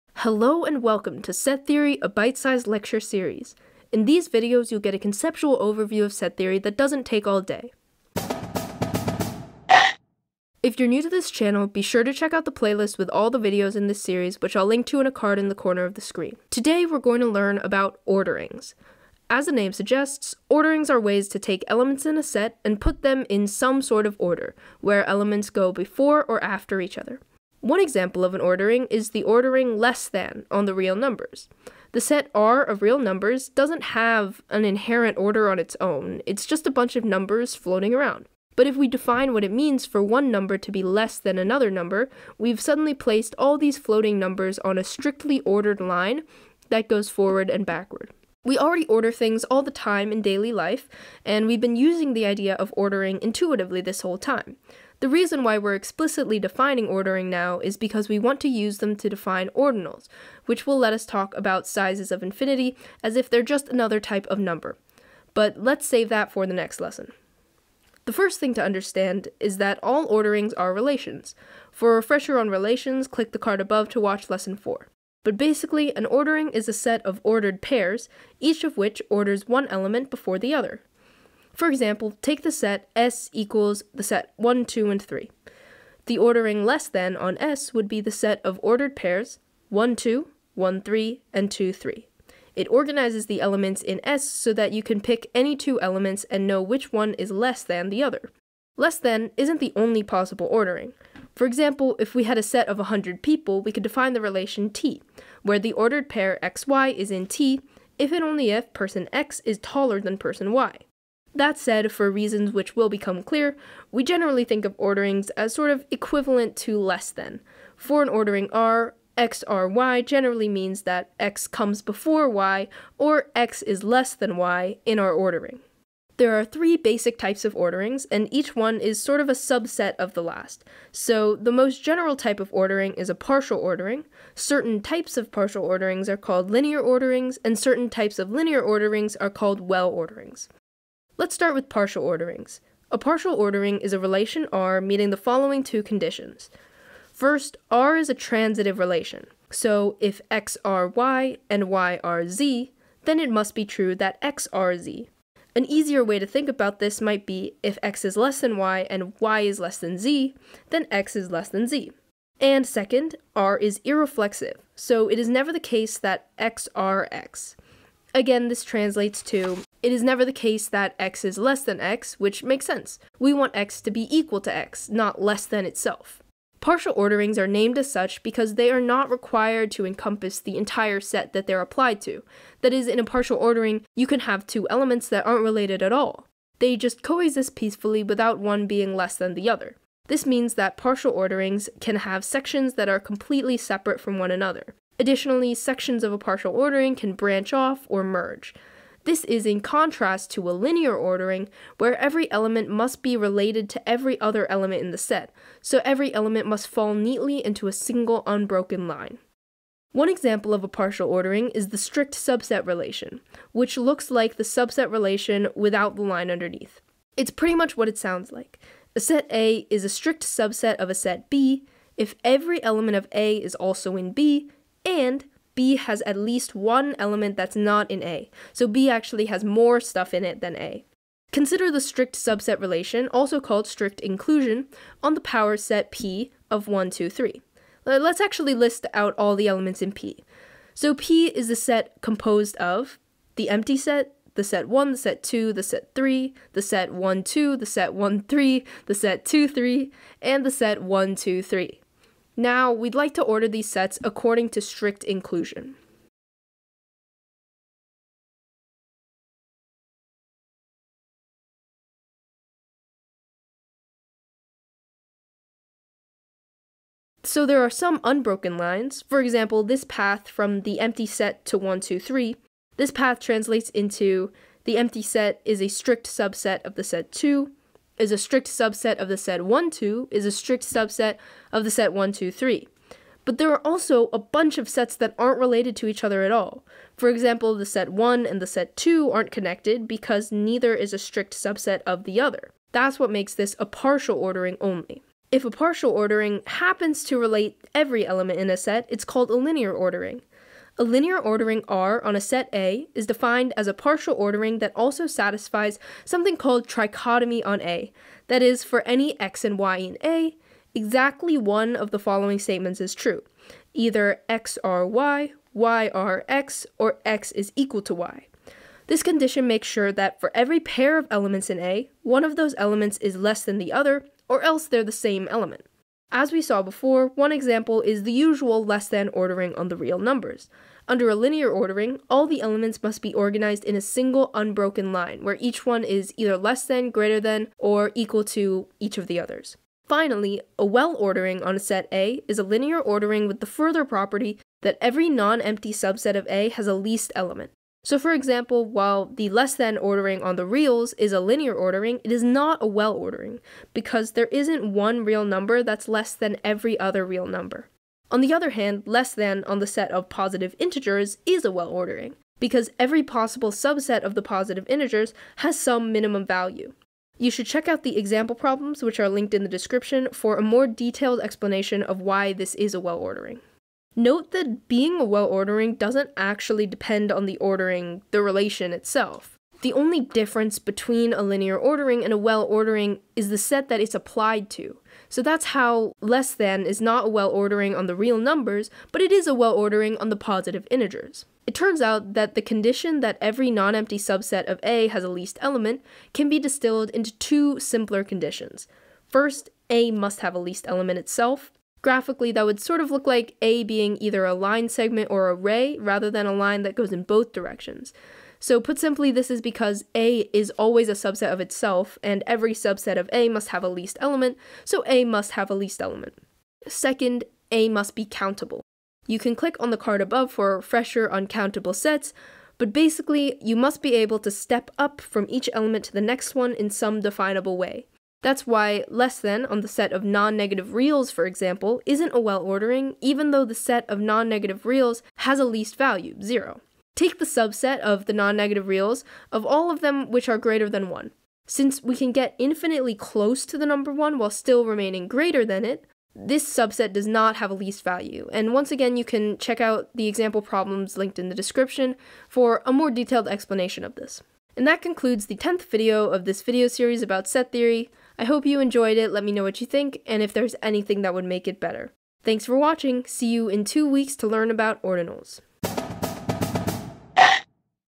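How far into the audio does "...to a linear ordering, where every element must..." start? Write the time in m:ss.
3:20.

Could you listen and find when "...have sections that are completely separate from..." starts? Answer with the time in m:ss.
3:11.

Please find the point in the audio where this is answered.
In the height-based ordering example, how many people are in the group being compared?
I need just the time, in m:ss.
1:42.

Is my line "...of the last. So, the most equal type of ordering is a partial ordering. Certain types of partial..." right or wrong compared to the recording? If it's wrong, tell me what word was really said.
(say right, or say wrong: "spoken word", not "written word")
wrong: "general", not "equal".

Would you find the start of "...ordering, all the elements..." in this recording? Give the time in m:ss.
5:31.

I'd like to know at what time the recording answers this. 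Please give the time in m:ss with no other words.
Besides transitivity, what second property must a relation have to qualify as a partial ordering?
2:43.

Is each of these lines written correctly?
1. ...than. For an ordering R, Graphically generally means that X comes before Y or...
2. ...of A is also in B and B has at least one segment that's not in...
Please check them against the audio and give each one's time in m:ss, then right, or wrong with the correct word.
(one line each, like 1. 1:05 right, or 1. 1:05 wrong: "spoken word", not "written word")
1. 1:57 wrong: "XRY", not "Graphically"
2. 3:42 wrong: "element", not "segment".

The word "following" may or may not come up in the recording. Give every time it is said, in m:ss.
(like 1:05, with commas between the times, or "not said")
2:25, 5:11.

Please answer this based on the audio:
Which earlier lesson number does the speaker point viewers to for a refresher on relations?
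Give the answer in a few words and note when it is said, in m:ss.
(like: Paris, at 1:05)
4, at 1:14.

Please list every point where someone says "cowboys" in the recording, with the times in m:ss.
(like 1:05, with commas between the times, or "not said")
not said.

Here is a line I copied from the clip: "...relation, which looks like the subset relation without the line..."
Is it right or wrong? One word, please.
right.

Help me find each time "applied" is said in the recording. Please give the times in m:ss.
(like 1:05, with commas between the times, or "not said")
3:01, 6:23.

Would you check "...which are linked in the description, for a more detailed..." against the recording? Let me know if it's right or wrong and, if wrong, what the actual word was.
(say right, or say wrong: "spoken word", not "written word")
right.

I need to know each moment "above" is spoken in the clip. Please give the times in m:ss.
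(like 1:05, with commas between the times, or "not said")
1:13, 7:00.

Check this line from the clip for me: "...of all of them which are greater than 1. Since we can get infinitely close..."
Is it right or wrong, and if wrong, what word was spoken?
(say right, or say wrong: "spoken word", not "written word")
right.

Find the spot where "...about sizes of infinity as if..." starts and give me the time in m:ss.
1:01.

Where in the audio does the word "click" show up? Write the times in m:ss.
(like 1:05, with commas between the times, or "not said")
1:13, 6:59.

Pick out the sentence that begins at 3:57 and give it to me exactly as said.
Uh, let's actually list out all the elements in P.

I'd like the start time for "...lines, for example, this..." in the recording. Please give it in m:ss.
4:28.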